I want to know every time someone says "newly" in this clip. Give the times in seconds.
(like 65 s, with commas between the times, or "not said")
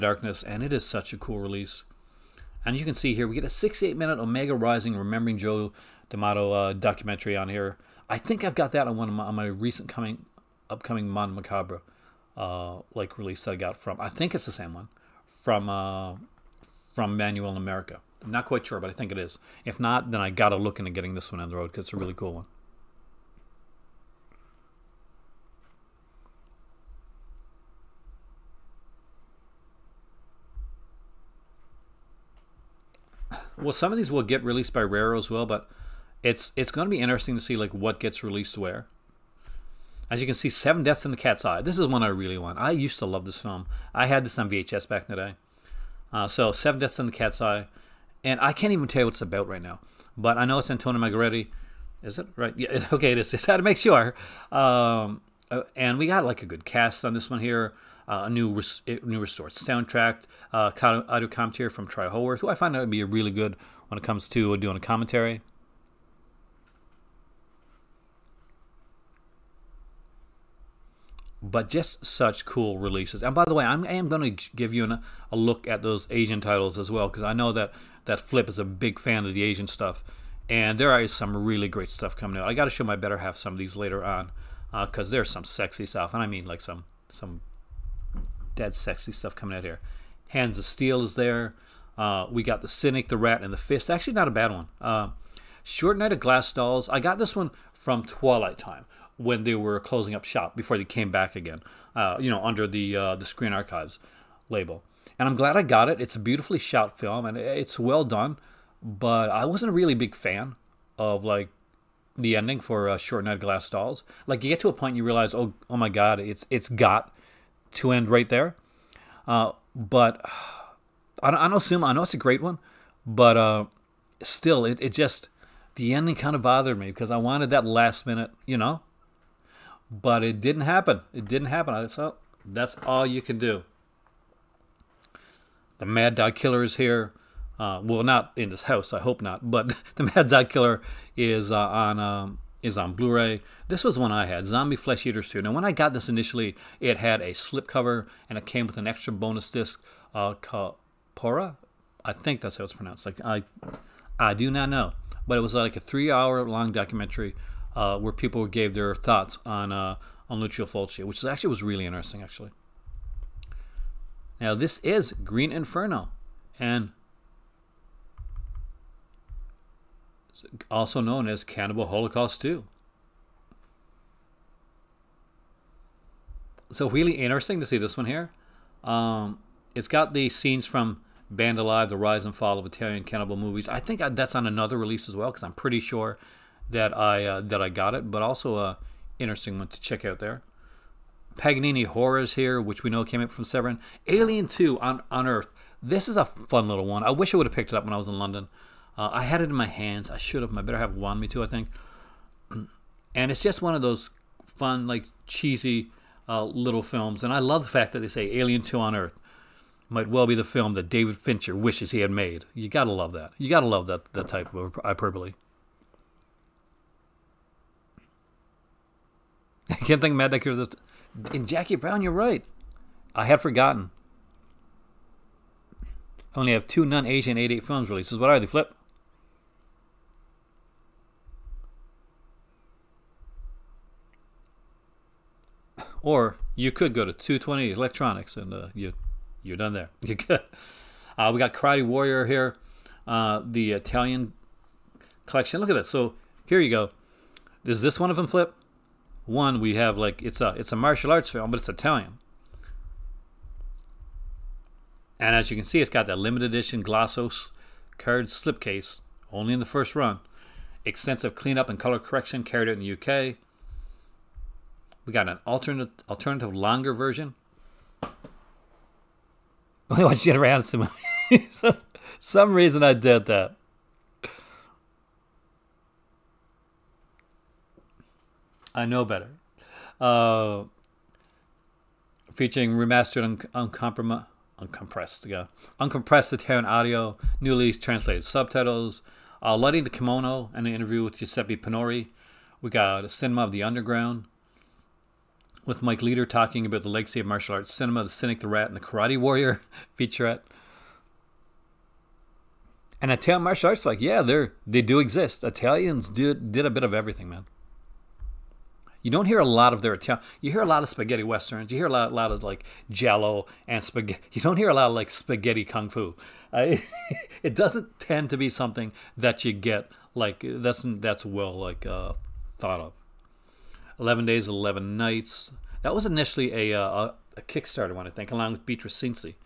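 287 s.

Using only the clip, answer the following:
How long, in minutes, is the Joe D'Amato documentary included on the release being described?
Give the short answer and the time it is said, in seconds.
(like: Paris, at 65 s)
68, at 3 s.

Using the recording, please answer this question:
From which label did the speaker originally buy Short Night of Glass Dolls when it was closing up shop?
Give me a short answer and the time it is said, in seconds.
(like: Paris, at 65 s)
Twilight Time, at 98 s.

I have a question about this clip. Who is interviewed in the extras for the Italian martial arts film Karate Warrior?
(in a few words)
Giuseppe Pinori.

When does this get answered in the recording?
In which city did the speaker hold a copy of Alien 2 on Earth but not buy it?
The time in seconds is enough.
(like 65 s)
198 s.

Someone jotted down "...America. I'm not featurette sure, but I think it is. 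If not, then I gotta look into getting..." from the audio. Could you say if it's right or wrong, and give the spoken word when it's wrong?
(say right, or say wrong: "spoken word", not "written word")
wrong: "quite", not "featurette".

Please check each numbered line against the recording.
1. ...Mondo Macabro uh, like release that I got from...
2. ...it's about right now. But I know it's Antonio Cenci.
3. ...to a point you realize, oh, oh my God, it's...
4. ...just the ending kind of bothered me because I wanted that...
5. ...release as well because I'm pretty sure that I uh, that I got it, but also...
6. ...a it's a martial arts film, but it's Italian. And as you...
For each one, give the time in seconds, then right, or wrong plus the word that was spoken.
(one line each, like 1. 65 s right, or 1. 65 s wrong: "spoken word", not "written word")
1. 11 s right
2. 49 s wrong: "Margheriti", not "Cenci"
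3. 114 s right
4. 124 s right
5. 184 s right
6. 250 s right.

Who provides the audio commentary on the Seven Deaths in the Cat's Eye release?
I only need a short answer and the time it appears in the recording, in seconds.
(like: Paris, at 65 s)
Troy Howarth, at 61 s.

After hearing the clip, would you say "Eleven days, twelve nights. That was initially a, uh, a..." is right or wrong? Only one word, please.
wrong.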